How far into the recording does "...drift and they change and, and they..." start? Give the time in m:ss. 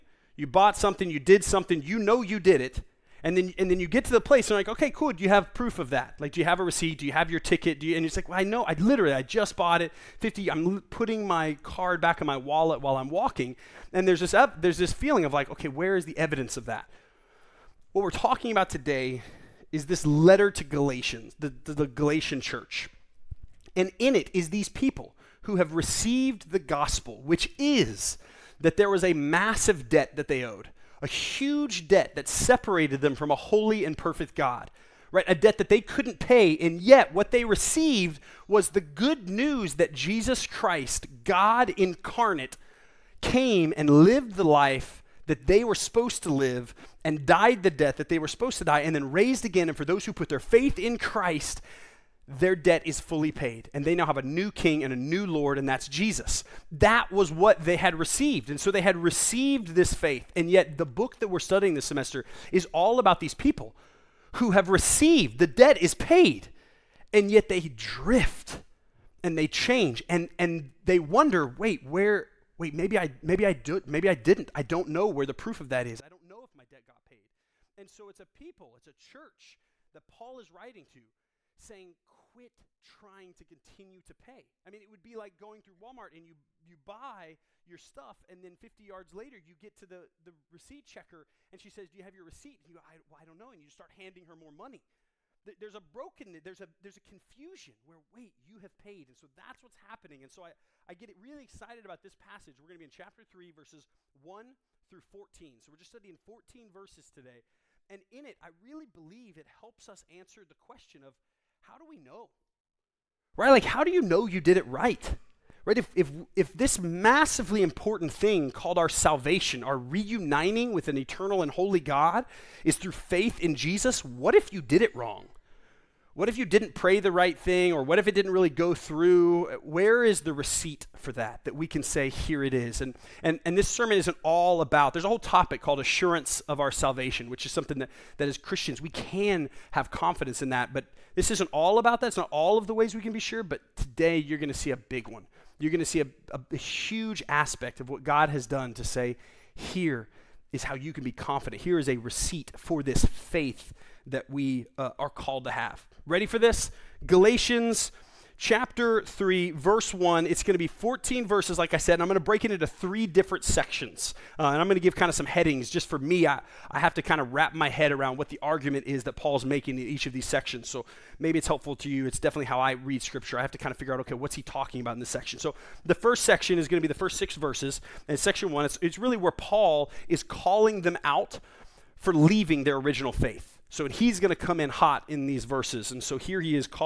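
1:07.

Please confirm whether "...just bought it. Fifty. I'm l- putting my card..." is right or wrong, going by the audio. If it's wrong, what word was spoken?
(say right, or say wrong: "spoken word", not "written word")
right.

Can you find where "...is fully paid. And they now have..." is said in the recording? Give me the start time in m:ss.
0:52.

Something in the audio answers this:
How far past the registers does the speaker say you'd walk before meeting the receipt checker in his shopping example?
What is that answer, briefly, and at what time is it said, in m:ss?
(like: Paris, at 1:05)
50 yards, at 1:28.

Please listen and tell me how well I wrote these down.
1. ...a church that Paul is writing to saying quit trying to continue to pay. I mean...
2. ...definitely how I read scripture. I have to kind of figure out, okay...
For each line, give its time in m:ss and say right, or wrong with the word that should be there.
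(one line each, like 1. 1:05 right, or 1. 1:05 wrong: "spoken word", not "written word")
1. 1:18 right
2. 2:52 right.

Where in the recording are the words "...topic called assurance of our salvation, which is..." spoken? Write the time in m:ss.
2:15.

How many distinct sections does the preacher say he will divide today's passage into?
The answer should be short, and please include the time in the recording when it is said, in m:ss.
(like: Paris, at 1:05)
3, at 2:42.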